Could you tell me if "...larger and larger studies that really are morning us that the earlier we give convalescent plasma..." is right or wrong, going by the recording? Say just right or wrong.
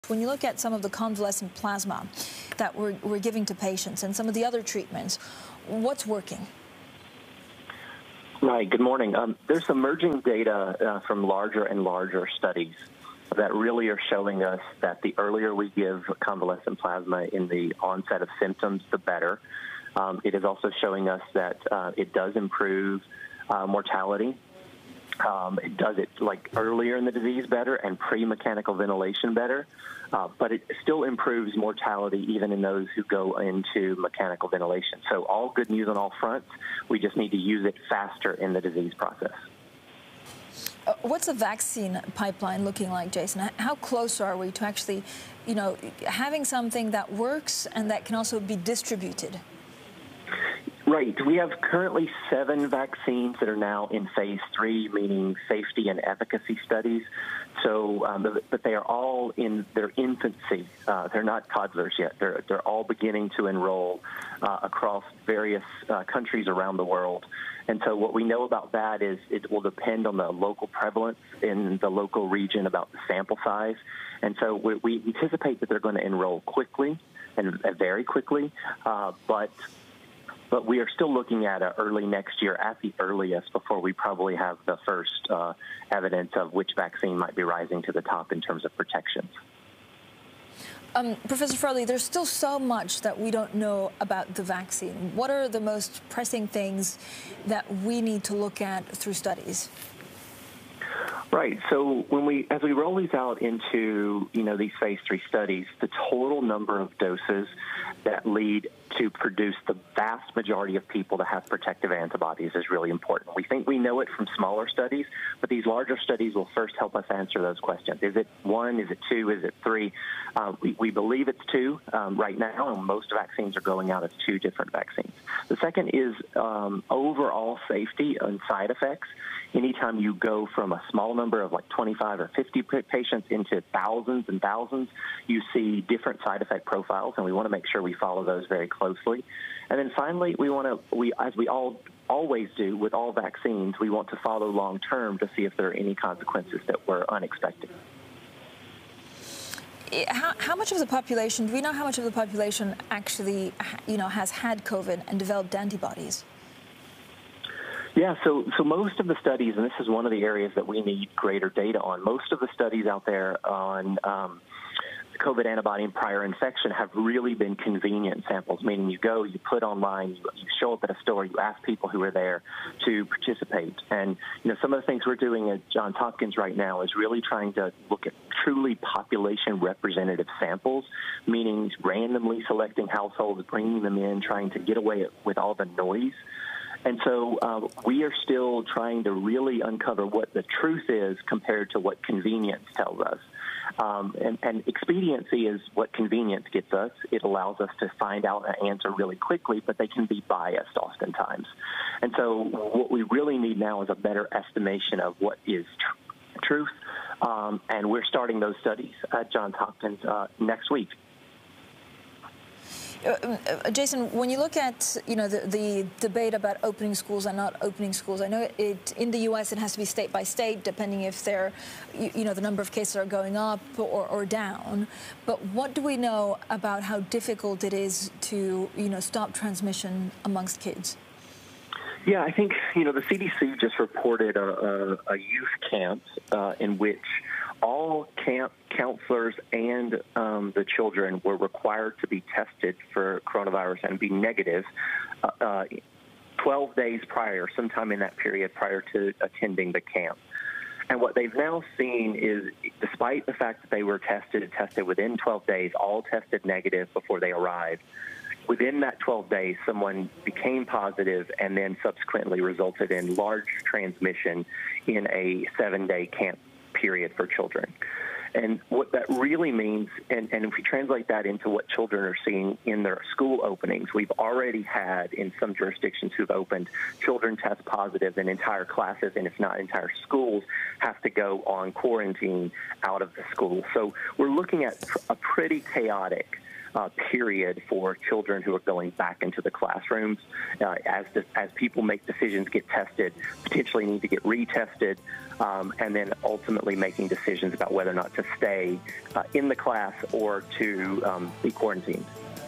wrong.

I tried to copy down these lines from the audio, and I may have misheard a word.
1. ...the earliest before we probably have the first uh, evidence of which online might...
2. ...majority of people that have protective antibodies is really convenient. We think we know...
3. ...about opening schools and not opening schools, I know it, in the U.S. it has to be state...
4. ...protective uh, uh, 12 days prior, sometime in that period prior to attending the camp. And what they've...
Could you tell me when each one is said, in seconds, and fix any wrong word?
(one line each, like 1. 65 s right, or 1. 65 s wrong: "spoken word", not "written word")
1. 82 s wrong: "vaccine", not "online"
2. 110 s wrong: "important", not "convenient"
3. 216 s right
4. 244 s wrong: "negative", not "protective".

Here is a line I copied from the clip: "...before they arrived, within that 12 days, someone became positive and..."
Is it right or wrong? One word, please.
right.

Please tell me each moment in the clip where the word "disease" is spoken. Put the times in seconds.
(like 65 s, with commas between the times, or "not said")
27 s, 38 s.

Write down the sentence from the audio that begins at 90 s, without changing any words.
Um, Professor Farley, there's still so much that we don't know about the vaccine.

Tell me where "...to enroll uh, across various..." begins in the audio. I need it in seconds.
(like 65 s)
63 s.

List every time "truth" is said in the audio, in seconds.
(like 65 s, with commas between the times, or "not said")
190 s, 206 s.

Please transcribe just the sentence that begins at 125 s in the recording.
The second is um, overall safety and side effects.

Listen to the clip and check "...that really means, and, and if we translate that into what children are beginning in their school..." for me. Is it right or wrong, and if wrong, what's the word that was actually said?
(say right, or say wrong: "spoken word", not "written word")
wrong: "seeing", not "beginning".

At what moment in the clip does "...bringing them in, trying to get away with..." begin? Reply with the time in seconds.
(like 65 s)
183 s.